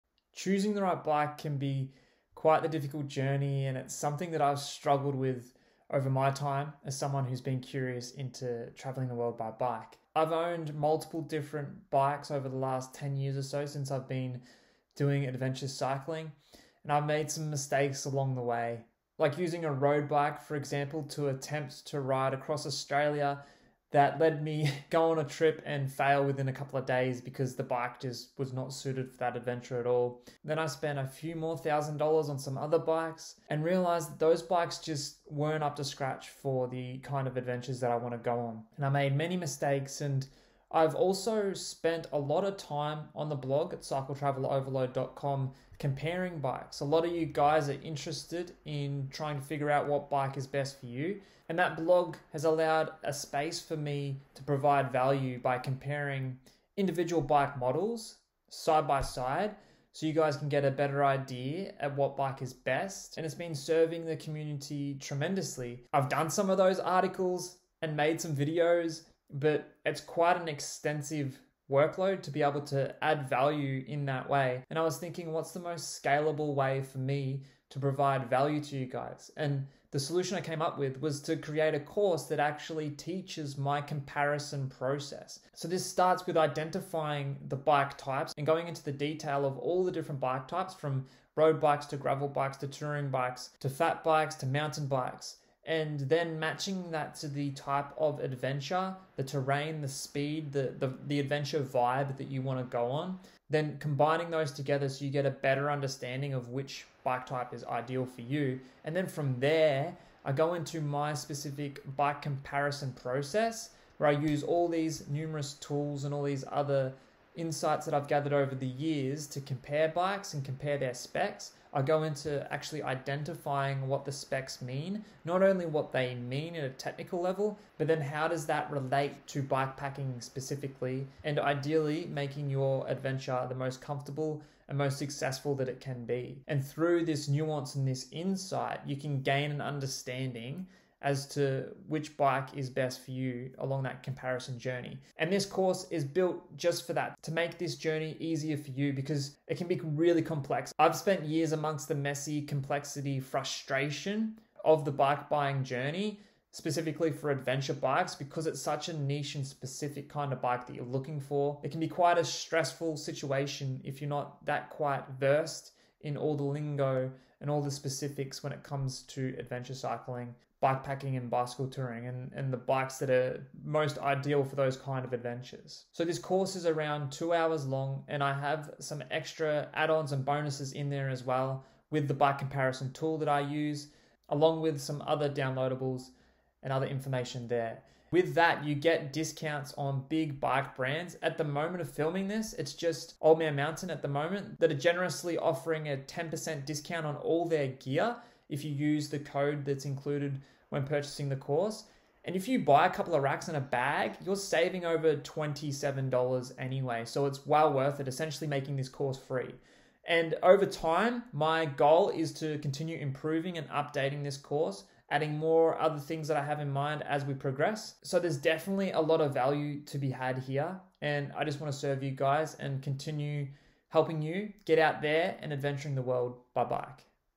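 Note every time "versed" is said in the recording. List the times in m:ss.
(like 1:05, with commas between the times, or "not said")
2:45.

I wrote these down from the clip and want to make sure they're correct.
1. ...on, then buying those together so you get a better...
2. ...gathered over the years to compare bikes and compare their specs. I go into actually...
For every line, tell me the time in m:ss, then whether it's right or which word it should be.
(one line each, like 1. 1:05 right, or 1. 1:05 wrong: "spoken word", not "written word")
1. 1:42 wrong: "combining", not "buying"
2. 1:58 right.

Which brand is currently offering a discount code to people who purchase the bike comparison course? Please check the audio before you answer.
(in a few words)
Old Man Mountain.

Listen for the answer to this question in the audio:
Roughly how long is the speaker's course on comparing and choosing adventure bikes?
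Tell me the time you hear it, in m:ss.
2:57.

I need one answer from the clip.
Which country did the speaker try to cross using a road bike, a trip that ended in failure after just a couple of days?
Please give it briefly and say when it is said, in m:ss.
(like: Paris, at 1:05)
Australia, at 0:22.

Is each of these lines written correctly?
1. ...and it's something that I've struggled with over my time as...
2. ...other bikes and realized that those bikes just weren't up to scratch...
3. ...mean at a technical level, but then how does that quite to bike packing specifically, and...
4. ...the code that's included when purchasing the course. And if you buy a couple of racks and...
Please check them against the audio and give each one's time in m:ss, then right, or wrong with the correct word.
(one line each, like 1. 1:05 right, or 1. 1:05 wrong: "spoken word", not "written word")
1. 0:03 right
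2. 0:32 right
3. 2:06 wrong: "relate", not "quite"
4. 3:19 right.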